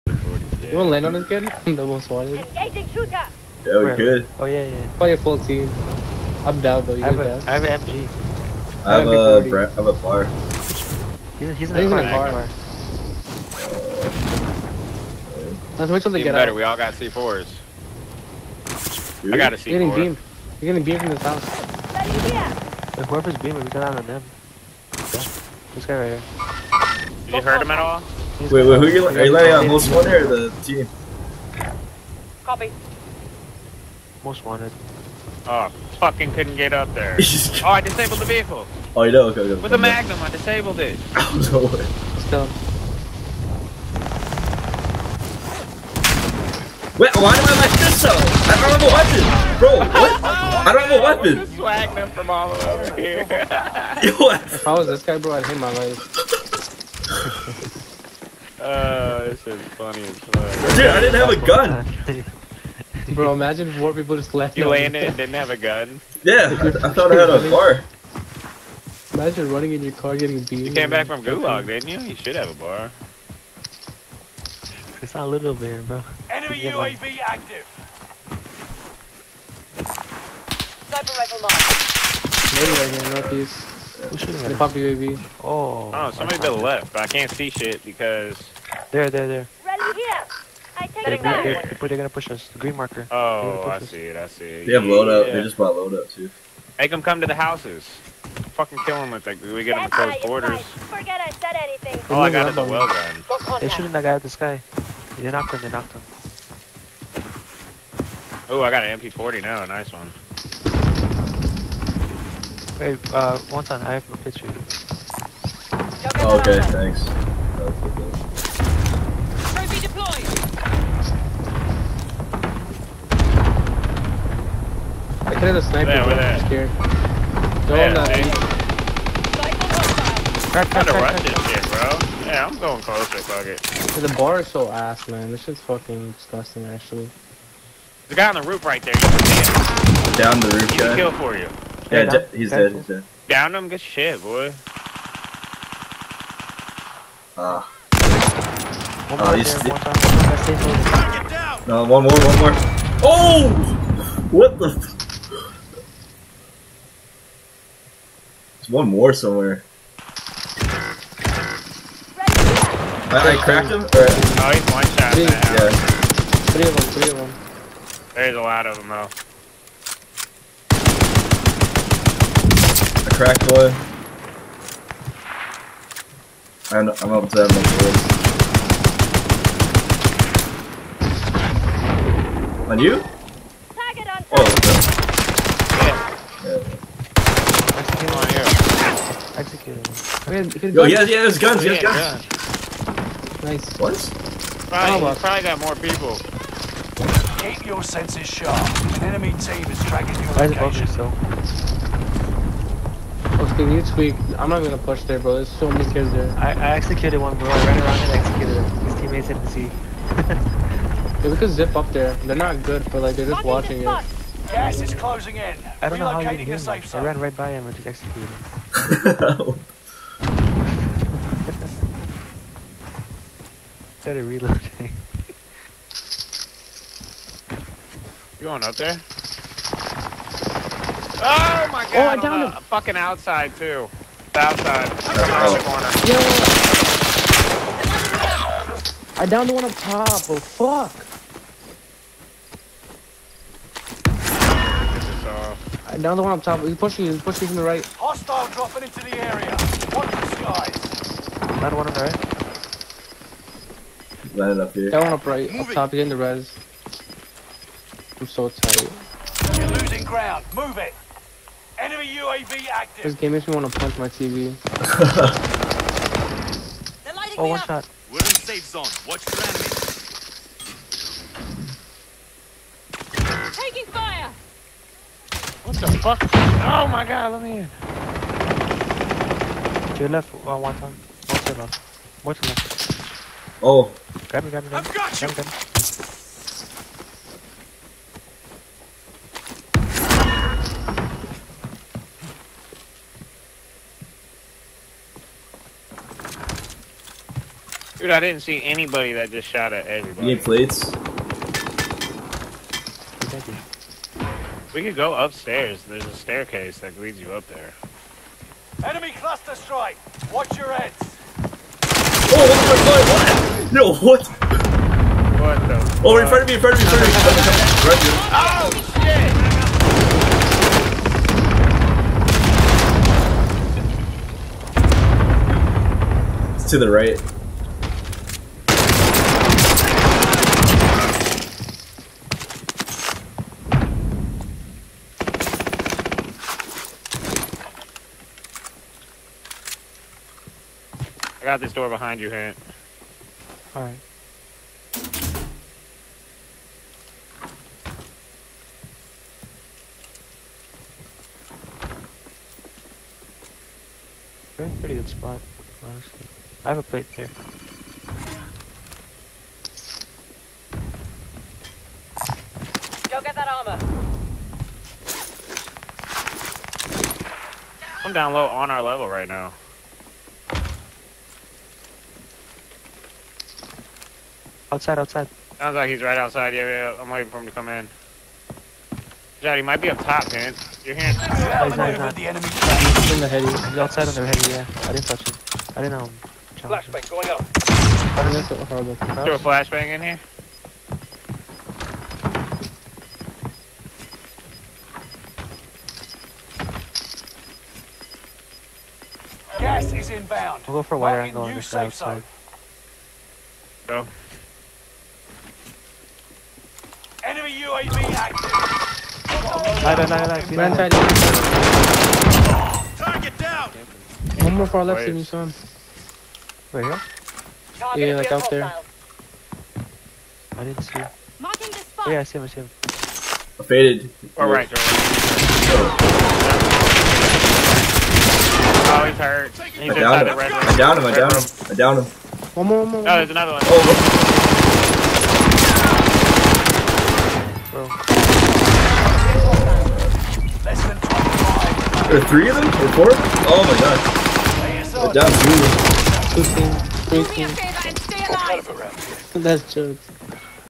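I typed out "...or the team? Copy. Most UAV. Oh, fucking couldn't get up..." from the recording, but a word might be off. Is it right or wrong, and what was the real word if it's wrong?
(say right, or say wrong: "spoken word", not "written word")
wrong: "Wanted", not "UAV".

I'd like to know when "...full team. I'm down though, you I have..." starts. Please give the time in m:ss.
0:05.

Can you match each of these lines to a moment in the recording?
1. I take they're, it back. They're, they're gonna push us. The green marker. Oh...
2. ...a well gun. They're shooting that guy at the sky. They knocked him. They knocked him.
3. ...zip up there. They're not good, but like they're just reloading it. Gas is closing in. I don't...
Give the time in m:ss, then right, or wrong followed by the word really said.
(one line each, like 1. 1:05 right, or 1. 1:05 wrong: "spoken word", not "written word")
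1. 1:30 right
2. 1:42 right
3. 3:31 wrong: "watching", not "reloading".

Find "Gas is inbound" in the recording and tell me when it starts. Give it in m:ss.
6:39.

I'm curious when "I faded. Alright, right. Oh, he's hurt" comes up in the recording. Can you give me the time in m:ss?
7:03.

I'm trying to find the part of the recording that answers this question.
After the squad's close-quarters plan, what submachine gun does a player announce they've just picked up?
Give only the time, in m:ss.
1:48.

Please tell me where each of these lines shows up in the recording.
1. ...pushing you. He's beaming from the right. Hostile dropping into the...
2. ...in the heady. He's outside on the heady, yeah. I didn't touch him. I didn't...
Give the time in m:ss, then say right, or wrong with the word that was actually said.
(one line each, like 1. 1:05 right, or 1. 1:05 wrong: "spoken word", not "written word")
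1. 4:06 wrong: "pushing", not "beaming"
2. 6:23 right.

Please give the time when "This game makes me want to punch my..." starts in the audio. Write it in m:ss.
4:23.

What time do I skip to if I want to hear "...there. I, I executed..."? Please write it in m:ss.
3:26.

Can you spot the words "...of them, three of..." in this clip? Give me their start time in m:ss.
2:46.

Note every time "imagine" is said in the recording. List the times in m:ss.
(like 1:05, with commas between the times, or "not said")
1:03, 1:09.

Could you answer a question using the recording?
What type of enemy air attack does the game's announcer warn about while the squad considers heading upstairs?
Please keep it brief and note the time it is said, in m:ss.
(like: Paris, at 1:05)
Cluster strike, at 5:08.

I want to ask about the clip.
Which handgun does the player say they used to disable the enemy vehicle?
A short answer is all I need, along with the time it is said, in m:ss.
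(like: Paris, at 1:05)
Magnum, at 0:39.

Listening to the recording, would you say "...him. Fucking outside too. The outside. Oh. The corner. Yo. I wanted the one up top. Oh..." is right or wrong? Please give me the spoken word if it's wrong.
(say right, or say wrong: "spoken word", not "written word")
wrong: "downed", not "wanted".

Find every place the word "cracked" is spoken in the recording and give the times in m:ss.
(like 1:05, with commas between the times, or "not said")
2:43, 2:53.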